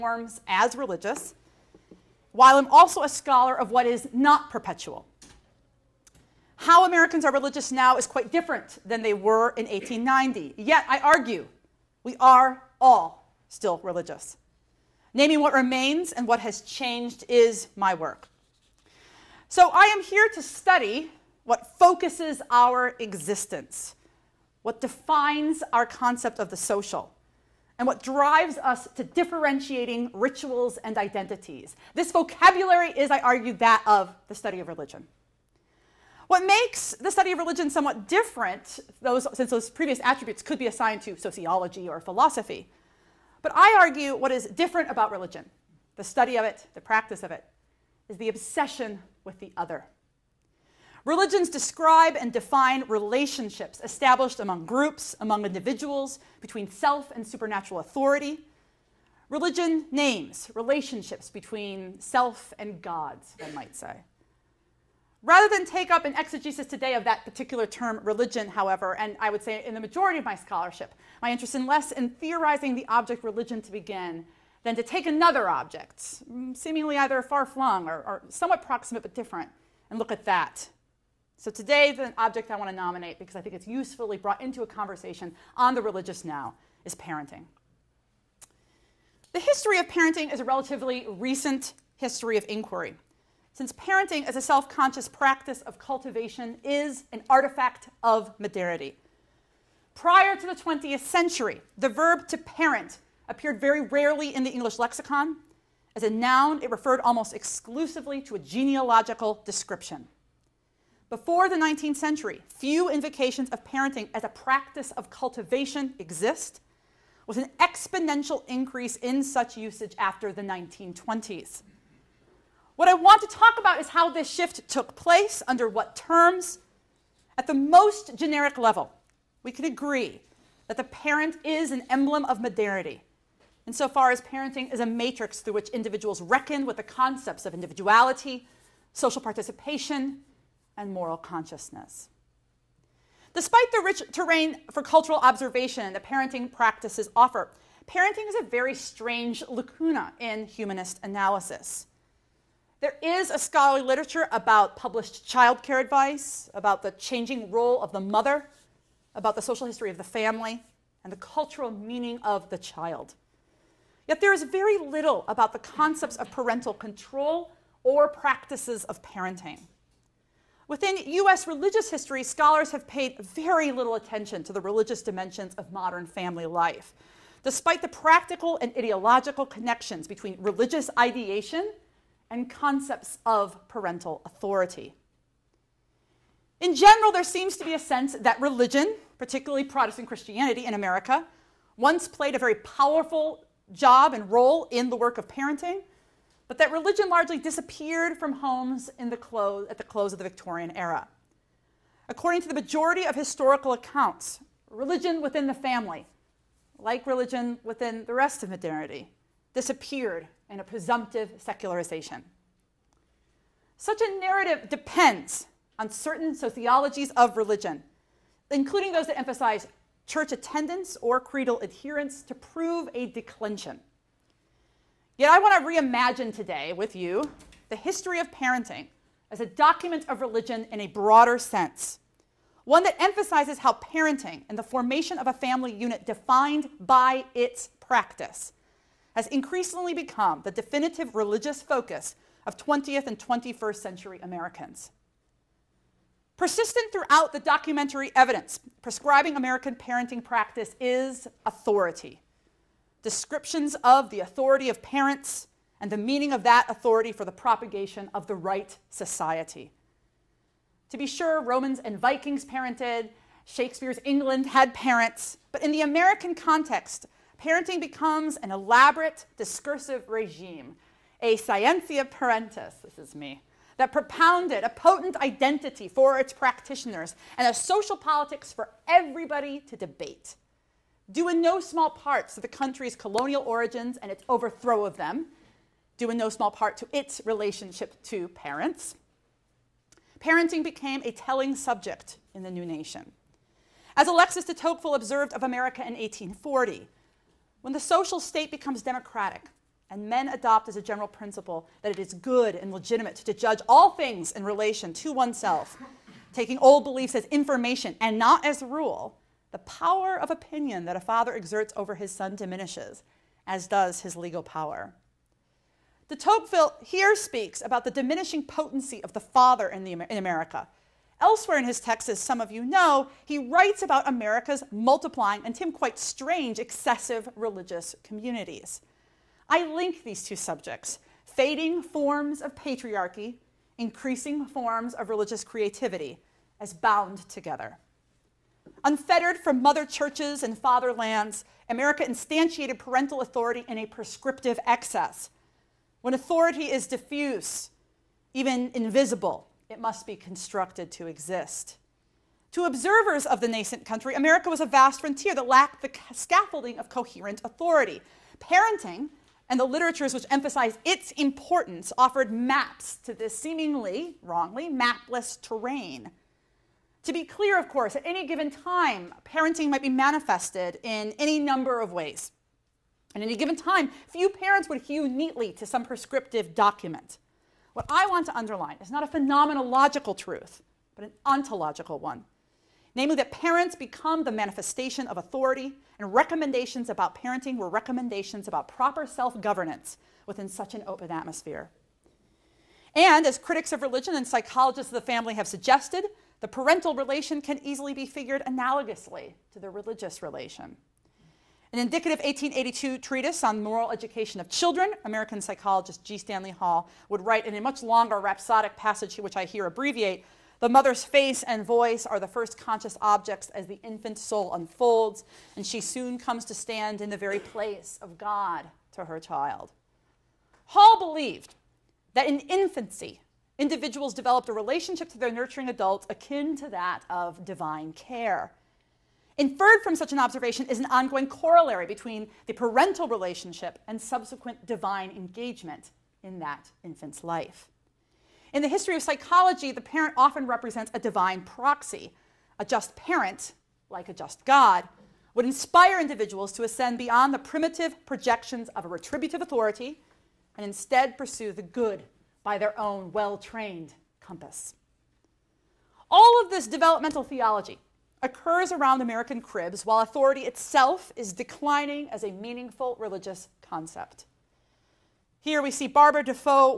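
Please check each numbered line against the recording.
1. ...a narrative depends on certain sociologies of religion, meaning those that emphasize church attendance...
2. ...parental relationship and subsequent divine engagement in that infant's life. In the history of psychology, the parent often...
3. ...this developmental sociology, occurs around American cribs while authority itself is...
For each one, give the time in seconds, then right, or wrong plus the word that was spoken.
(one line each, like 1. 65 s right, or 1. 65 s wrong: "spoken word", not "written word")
1. 214 s wrong: "including", not "meaning"
2. 432 s right
3. 456 s wrong: "theology", not "sociology".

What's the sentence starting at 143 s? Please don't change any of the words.
Despite the rich terrain for cultural observation that parenting practices offer, parenting is a very strange lacuna in humanist analysis.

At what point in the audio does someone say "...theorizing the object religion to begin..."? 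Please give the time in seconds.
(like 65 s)
72 s.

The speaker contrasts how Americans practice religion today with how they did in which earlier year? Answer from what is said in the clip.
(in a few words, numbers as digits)
1890.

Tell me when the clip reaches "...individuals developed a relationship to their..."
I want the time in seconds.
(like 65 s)
423 s.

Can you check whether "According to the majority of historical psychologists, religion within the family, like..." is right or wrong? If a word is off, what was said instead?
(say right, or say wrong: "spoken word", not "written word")
wrong: "accounts", not "psychologists".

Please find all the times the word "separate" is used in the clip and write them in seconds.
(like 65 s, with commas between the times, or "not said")
not said.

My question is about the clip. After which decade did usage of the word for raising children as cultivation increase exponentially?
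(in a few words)
1920s.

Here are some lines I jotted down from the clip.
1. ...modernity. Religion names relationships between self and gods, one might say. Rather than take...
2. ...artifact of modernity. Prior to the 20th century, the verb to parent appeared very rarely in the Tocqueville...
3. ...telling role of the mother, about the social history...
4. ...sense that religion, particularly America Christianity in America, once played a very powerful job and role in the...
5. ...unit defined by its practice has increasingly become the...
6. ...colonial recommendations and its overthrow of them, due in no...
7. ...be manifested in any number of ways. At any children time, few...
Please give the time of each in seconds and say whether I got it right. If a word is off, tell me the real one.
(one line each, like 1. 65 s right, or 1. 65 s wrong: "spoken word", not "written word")
1. 57 s wrong: "authority", not "modernity"
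2. 97 s wrong: "English", not "Tocqueville"
3. 156 s wrong: "changing", not "telling"
4. 187 s wrong: "Protestant", not "America"
5. 235 s right
6. 282 s wrong: "origins", not "recommendations"
7. 369 s wrong: "given", not "children".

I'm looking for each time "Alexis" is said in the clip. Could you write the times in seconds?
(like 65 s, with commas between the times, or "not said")
294 s.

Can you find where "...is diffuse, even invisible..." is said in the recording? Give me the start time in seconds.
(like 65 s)
346 s.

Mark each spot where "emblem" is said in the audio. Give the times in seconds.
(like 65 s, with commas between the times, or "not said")
131 s.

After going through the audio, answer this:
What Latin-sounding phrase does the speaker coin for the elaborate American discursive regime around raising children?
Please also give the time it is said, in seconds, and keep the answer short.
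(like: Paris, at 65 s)
scientia parentis, at 271 s.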